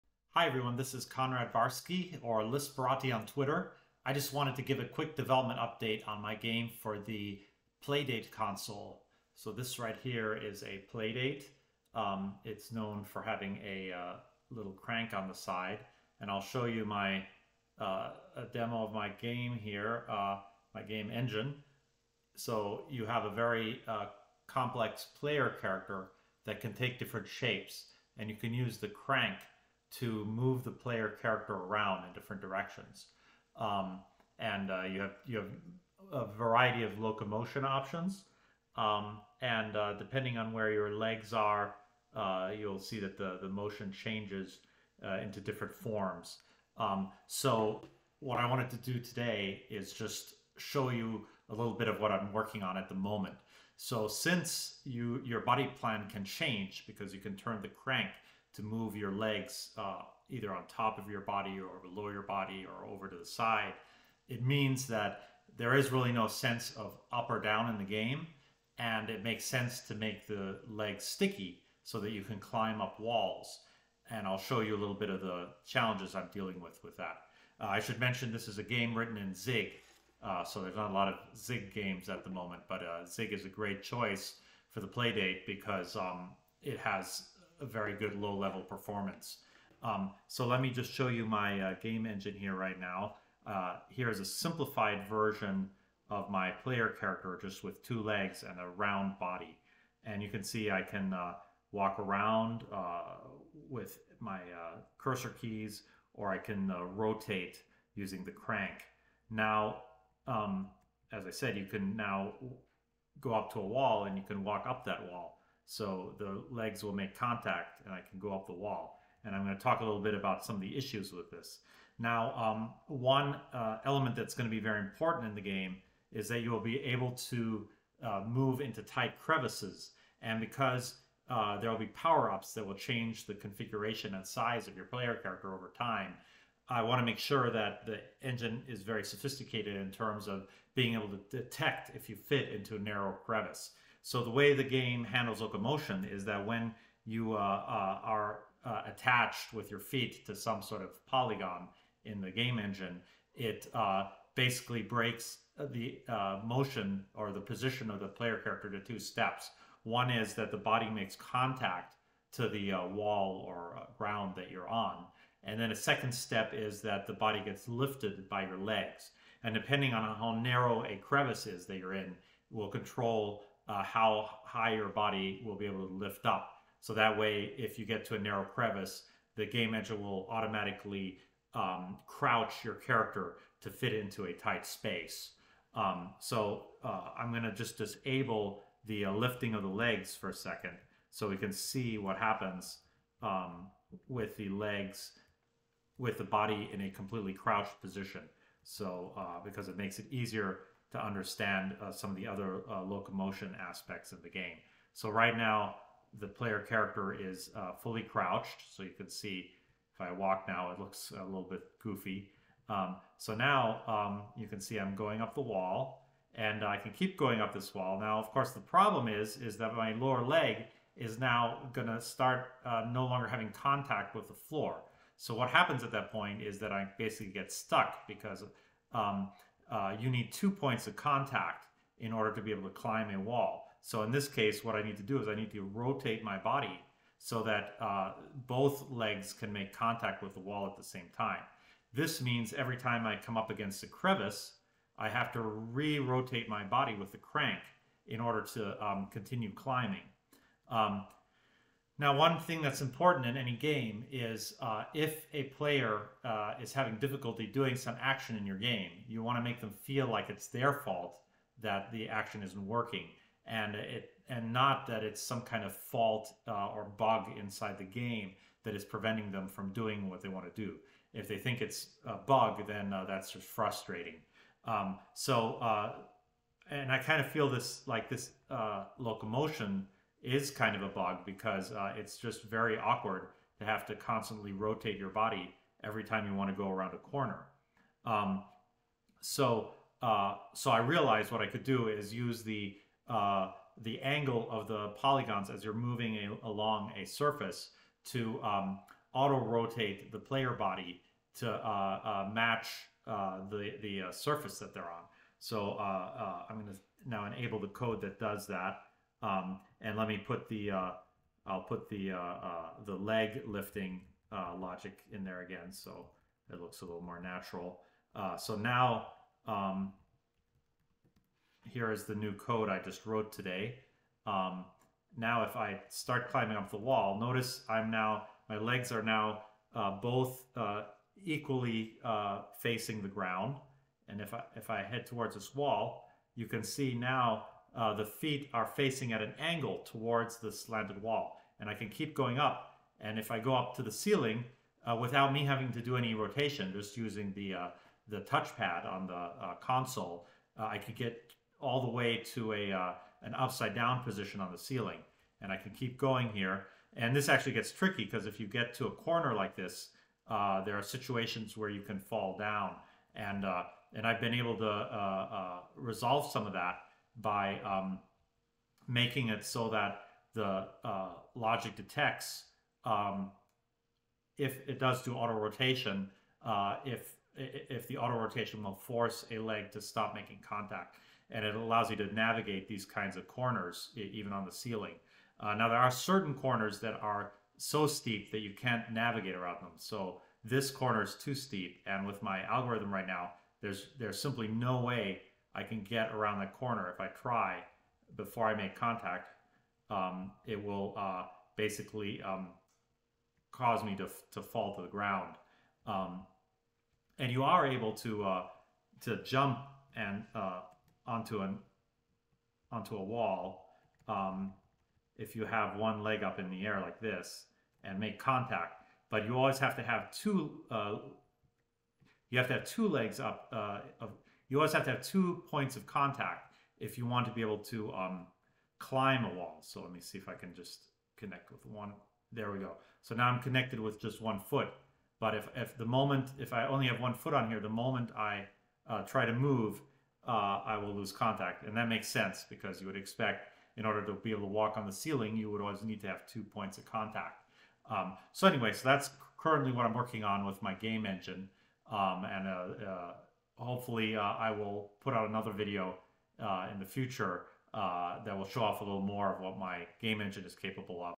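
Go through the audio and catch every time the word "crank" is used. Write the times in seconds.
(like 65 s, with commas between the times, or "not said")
14 s, 28 s, 57 s, 108 s, 247 s.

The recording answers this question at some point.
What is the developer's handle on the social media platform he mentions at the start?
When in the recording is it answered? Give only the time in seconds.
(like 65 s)
2 s.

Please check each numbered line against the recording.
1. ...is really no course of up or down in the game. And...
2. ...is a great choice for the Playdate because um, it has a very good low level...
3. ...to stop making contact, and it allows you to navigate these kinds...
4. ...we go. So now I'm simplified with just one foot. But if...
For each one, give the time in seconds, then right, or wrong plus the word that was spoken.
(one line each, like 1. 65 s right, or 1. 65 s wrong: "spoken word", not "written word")
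1. 65 s wrong: "sense", not "course"
2. 83 s right
3. 379 s right
4. 432 s wrong: "connected", not "simplified".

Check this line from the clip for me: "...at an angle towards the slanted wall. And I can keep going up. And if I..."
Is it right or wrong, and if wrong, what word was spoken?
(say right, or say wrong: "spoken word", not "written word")
right.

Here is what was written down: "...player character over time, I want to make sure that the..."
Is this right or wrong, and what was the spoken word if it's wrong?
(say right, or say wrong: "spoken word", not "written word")
right.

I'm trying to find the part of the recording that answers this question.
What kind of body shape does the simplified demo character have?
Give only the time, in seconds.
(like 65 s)
98 s.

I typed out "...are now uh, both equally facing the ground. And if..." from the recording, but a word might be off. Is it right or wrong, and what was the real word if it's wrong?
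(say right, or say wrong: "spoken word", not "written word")
right.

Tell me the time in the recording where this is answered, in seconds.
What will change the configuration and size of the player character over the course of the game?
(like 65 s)
131 s.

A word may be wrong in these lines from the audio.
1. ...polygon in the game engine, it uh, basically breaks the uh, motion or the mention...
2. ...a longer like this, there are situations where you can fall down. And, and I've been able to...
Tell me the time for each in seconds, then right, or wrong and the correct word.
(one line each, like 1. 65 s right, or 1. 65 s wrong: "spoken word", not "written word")
1. 151 s wrong: "position", not "mention"
2. 358 s wrong: "corner", not "longer".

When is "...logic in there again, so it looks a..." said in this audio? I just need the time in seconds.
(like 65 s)
314 s.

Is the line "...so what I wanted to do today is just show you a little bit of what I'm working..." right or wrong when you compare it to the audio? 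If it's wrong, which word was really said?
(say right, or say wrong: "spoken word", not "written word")
right.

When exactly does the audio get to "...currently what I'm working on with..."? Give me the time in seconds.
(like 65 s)
449 s.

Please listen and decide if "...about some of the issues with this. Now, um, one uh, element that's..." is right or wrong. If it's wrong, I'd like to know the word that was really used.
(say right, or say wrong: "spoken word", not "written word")
right.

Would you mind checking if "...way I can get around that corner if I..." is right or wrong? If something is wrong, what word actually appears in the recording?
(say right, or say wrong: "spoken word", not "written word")
right.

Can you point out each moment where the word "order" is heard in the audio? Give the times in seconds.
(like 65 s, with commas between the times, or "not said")
232 s, 248 s, 443 s.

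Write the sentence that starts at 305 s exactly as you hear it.
So I'm going to now enable the code that does that.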